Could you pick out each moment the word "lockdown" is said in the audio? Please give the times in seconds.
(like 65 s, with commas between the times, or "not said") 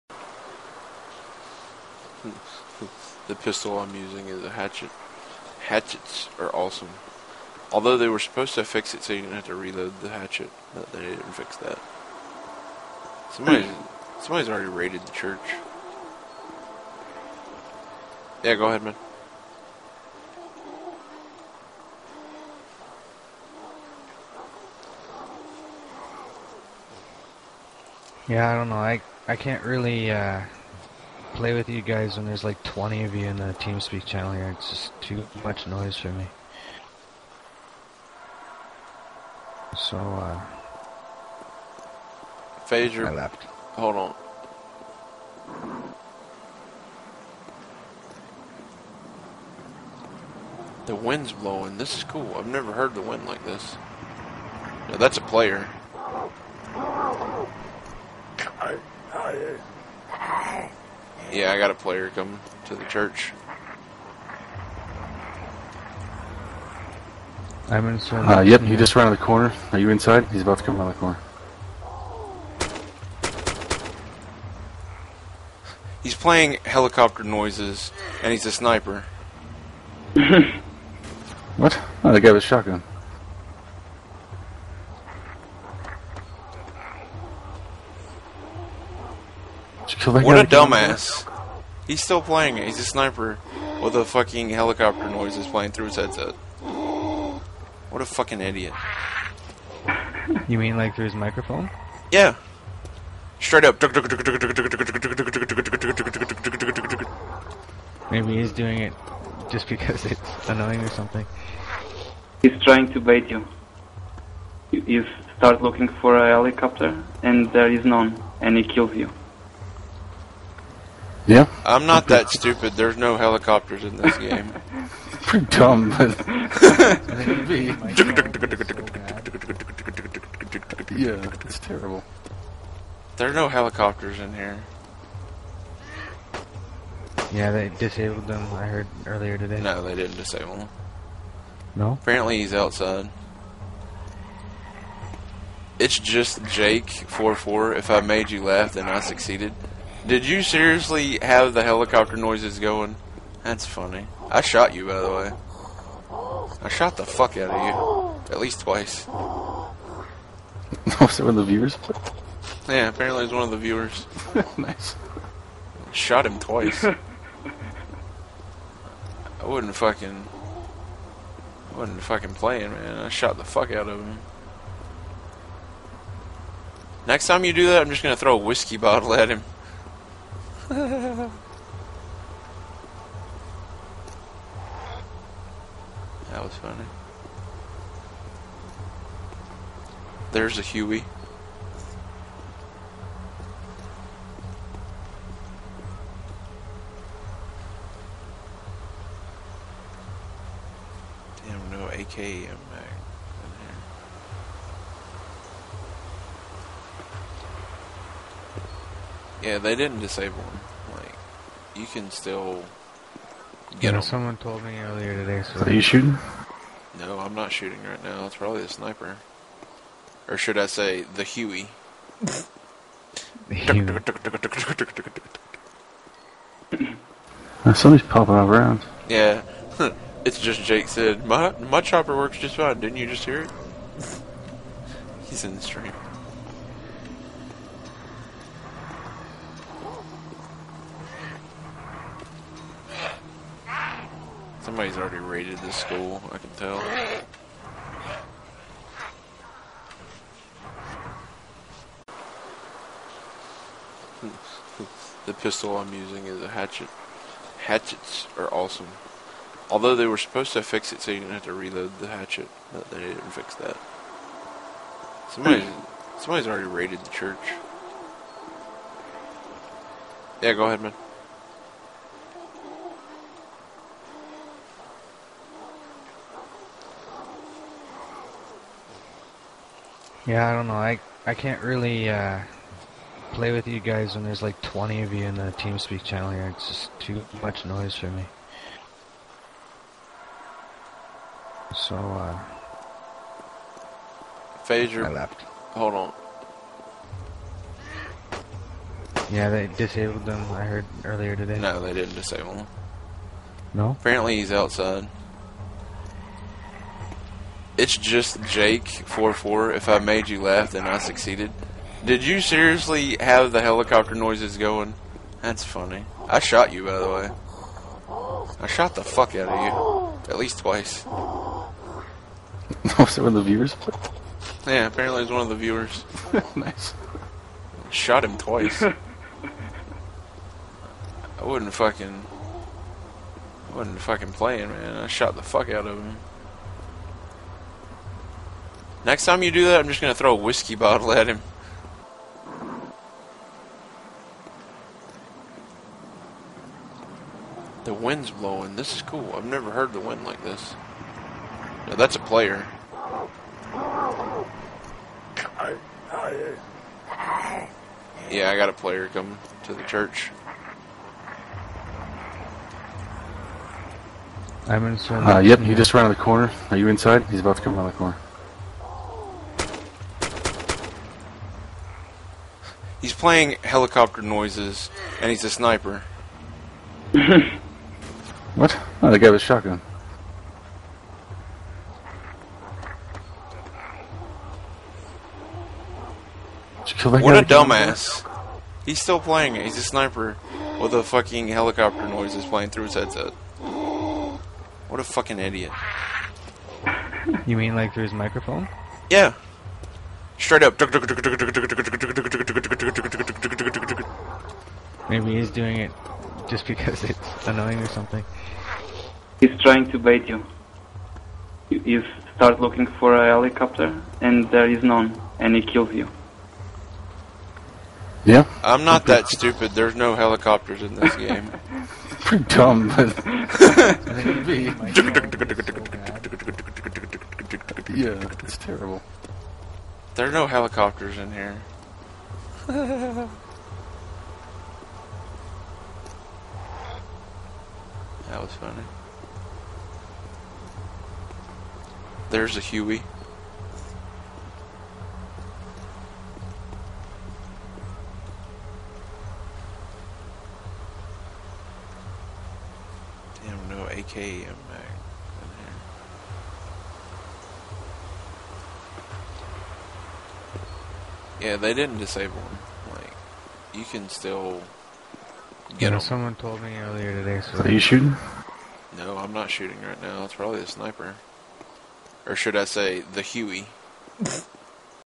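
not said.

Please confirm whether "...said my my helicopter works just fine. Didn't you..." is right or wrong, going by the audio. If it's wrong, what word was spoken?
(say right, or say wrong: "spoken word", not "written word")
wrong: "chopper", not "helicopter".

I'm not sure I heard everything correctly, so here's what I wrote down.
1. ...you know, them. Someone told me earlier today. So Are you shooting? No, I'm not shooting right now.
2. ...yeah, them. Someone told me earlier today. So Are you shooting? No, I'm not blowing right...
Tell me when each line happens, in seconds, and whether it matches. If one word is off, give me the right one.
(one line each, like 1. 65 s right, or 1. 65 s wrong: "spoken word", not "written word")
1. 213 s right
2. 465 s wrong: "shooting", not "blowing".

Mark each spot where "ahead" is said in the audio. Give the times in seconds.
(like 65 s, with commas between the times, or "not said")
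18 s, 270 s.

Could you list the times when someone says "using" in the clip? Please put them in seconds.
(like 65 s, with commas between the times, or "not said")
3 s, 255 s.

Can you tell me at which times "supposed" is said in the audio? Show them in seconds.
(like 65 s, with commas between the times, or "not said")
8 s, 260 s.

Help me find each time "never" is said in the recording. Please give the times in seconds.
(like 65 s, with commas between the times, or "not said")
52 s, 349 s.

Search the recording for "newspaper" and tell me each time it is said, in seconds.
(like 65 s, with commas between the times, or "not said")
not said.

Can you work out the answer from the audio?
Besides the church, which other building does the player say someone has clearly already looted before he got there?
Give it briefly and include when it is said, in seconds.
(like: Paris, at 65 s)
school, at 245 s.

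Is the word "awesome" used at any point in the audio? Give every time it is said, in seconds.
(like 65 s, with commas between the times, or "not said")
6 s, 258 s.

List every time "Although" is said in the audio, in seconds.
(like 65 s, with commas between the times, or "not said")
7 s, 259 s.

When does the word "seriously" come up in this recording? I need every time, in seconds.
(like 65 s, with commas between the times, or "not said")
150 s, 312 s.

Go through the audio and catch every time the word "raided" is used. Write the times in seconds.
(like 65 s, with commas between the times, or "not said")
14 s, 245 s, 266 s.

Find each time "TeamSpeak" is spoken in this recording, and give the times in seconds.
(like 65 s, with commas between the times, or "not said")
33 s, 285 s.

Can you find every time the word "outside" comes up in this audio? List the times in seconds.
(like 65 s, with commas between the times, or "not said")
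142 s, 304 s.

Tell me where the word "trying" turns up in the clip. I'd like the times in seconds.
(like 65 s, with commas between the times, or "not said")
112 s, 409 s.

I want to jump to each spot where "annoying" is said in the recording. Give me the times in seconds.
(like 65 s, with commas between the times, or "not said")
110 s, 407 s.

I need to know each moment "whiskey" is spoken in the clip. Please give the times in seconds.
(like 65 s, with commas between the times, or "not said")
178 s, 340 s.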